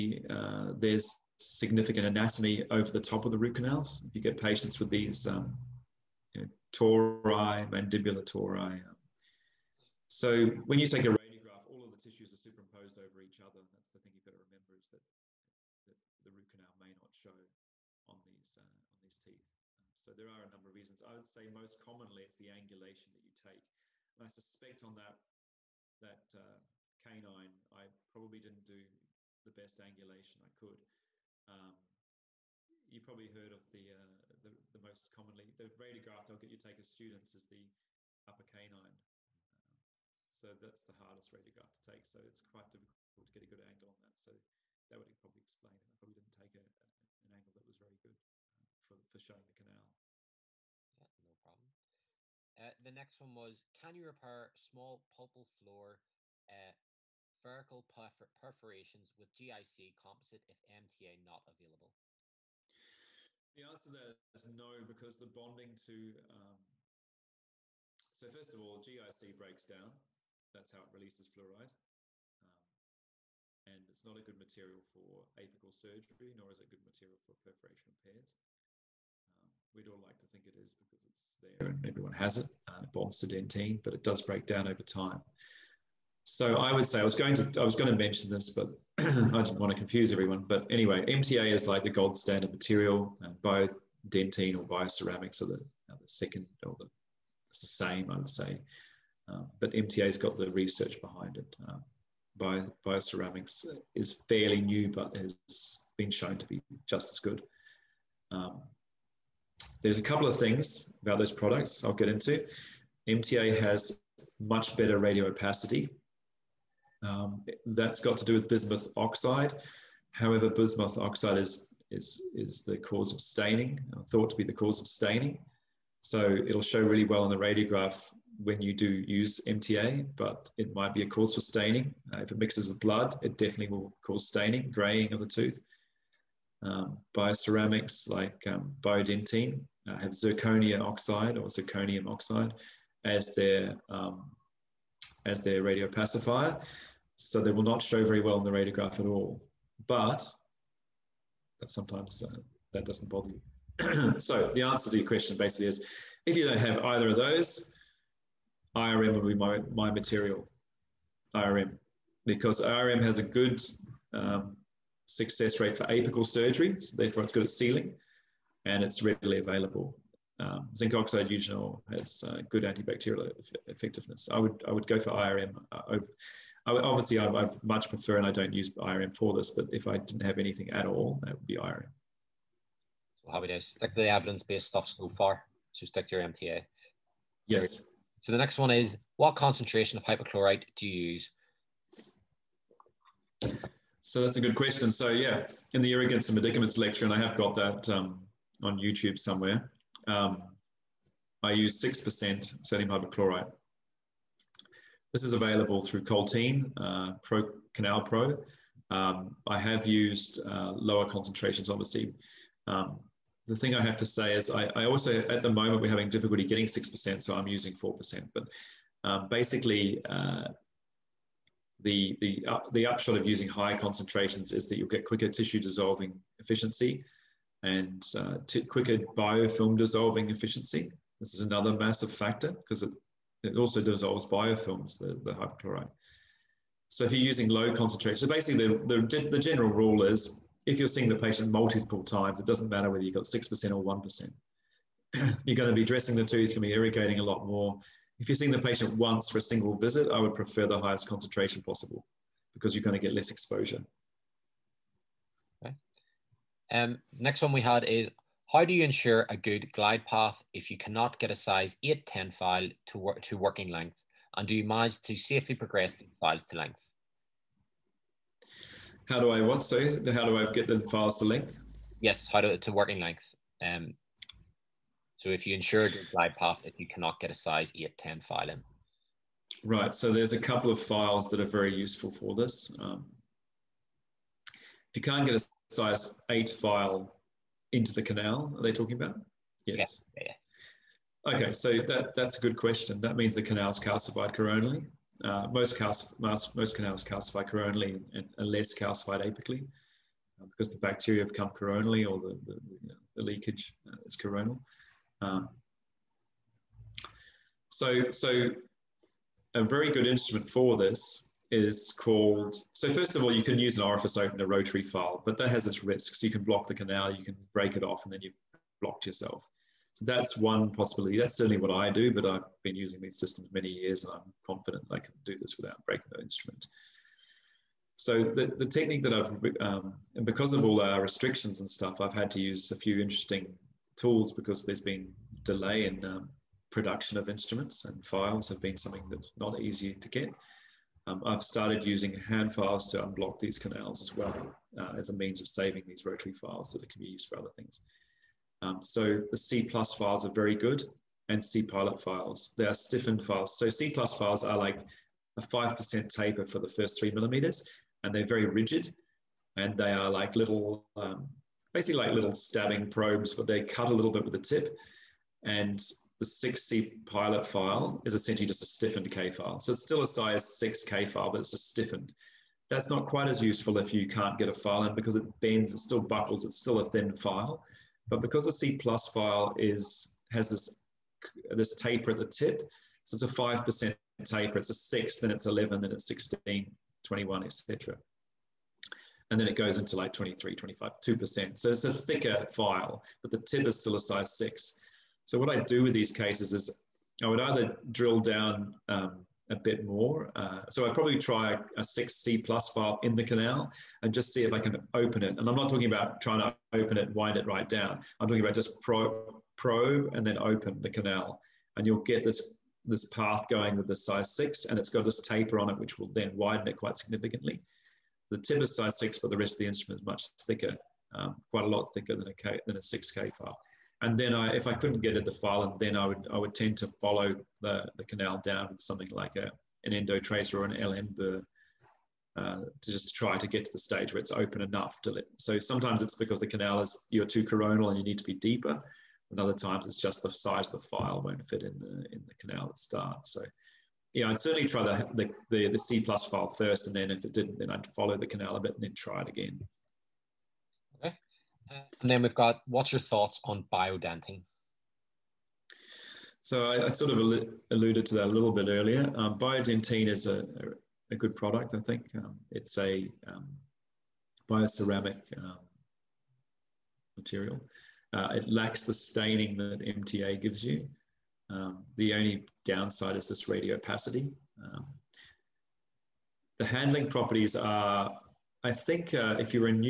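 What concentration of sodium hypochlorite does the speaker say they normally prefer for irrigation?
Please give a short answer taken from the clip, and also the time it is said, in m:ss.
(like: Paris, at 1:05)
6%, at 3:21.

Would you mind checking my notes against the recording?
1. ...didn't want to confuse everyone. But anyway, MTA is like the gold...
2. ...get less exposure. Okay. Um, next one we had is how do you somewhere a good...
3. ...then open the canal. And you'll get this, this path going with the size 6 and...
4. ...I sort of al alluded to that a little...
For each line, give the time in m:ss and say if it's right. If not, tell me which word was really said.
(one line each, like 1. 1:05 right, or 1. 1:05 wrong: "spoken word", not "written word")
1. 1:29 right
2. 4:13 wrong: "ensure", not "somewhere"
3. 6:50 right
4. 7:36 right.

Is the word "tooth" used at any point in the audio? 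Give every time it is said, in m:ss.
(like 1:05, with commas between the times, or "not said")
2:15, 4:06.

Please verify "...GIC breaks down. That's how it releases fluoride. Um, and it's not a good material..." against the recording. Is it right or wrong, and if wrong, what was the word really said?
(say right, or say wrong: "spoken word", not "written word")
right.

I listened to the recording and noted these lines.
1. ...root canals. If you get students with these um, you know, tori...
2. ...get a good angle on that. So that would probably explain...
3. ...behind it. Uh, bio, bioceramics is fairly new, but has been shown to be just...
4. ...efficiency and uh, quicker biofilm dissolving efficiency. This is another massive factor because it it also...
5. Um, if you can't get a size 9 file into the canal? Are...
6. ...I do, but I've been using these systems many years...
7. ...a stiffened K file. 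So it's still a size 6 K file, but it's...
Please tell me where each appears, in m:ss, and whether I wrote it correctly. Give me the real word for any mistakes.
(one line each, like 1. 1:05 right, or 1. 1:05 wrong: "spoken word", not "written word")
1. 0:03 wrong: "patients", not "students"
2. 0:43 right
3. 1:41 right
4. 3:46 right
5. 4:42 wrong: "8", not "9"
6. 5:21 right
7. 6:08 right.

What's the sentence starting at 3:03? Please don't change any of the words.
So how it is, stick to the evidence-based stuff so far.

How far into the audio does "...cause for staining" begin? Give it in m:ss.
2:11.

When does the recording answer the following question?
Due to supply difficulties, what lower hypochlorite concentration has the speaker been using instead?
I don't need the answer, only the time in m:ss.
3:37.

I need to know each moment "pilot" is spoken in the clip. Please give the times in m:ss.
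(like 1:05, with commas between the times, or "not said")
5:51, 6:07.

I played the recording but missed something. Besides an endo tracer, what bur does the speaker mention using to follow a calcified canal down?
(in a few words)
LM burr.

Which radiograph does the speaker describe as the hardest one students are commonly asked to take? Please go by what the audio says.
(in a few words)
Upper canine.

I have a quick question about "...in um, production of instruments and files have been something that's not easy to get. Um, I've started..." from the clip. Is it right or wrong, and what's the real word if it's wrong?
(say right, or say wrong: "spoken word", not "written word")
right.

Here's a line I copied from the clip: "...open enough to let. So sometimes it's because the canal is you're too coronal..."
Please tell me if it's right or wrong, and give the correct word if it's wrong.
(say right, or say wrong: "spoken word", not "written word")
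right.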